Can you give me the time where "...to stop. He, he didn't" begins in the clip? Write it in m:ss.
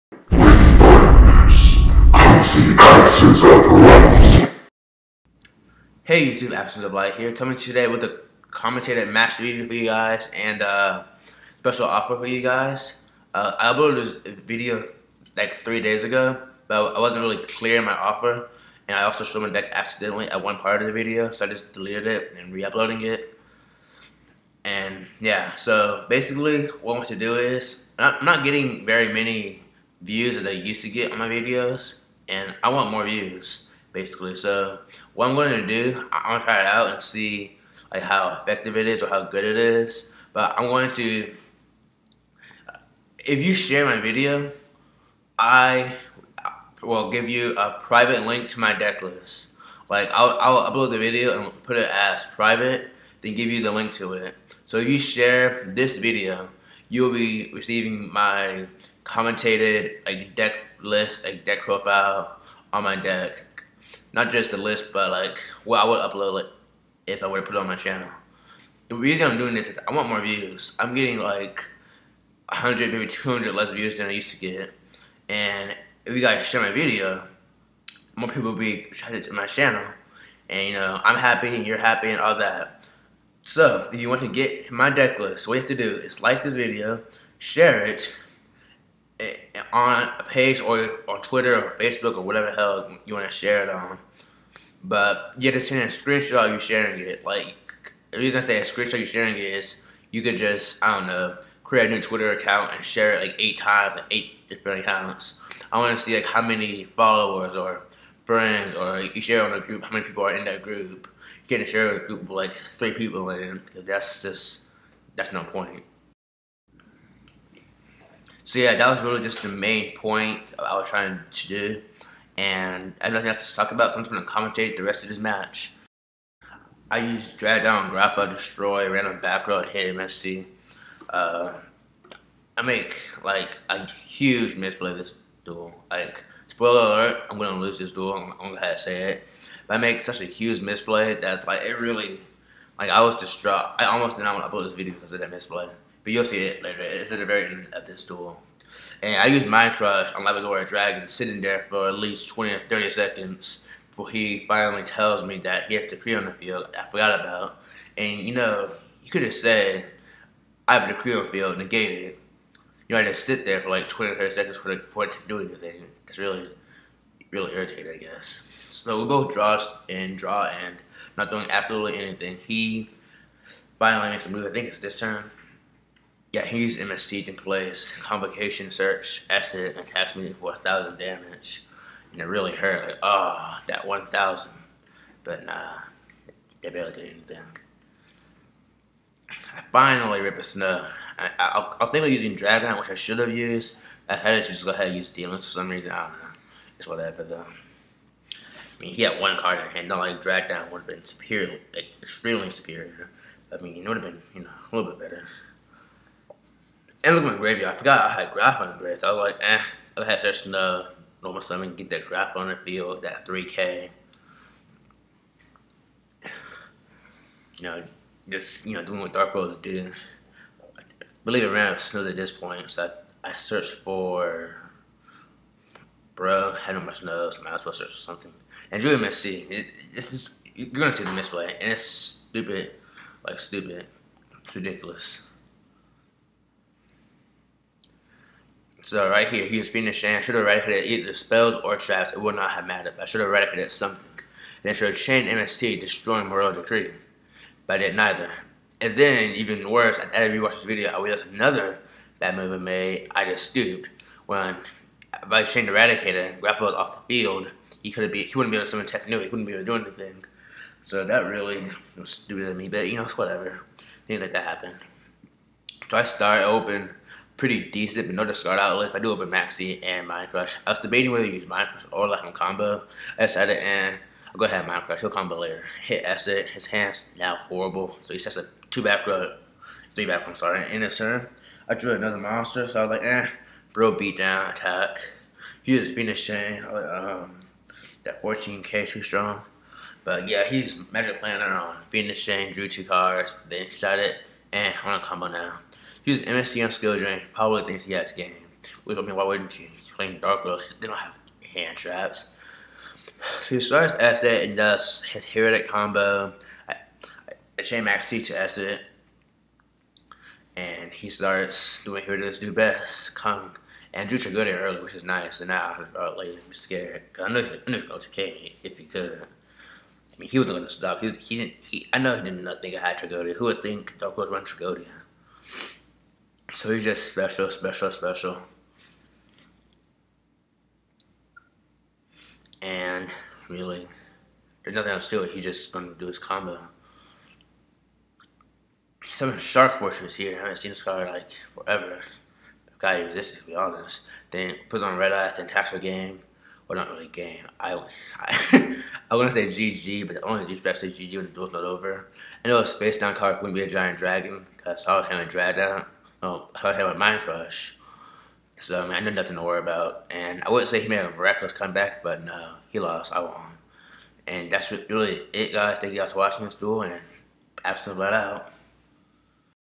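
5:20.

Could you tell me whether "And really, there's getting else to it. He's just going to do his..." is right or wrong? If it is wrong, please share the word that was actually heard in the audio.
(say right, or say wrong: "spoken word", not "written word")
wrong: "nothing", not "getting".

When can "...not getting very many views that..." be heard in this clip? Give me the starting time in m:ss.
0:28.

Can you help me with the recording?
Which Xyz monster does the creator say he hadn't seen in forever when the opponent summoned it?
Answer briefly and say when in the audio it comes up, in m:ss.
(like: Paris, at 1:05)
Shark Fortress, at 5:39.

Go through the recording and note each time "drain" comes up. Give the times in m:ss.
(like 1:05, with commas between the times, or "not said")
4:56.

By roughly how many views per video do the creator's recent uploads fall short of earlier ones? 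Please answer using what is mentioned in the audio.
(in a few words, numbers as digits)
100 to 200.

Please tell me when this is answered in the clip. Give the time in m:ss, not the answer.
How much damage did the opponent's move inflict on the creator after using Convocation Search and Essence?
3:00.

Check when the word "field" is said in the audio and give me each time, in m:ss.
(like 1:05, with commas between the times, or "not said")
2:36, 2:41, 3:32, 4:17.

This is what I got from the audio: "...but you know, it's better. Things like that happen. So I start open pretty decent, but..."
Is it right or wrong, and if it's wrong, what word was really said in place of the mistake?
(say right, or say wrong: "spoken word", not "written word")
wrong: "whatever", not "better".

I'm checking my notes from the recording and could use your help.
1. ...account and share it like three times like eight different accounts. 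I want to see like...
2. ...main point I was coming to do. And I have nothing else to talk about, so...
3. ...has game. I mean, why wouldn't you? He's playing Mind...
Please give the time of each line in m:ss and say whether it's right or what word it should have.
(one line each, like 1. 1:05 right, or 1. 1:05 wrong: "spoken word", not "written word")
1. 1:42 wrong: "eight", not "three"
2. 1:59 wrong: "trying", not "coming"
3. 4:57 wrong: "Dark", not "Mind".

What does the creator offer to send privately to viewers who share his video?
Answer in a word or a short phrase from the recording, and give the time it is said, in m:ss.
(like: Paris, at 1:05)
deck profile, at 1:01.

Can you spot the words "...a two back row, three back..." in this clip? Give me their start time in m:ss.
4:38.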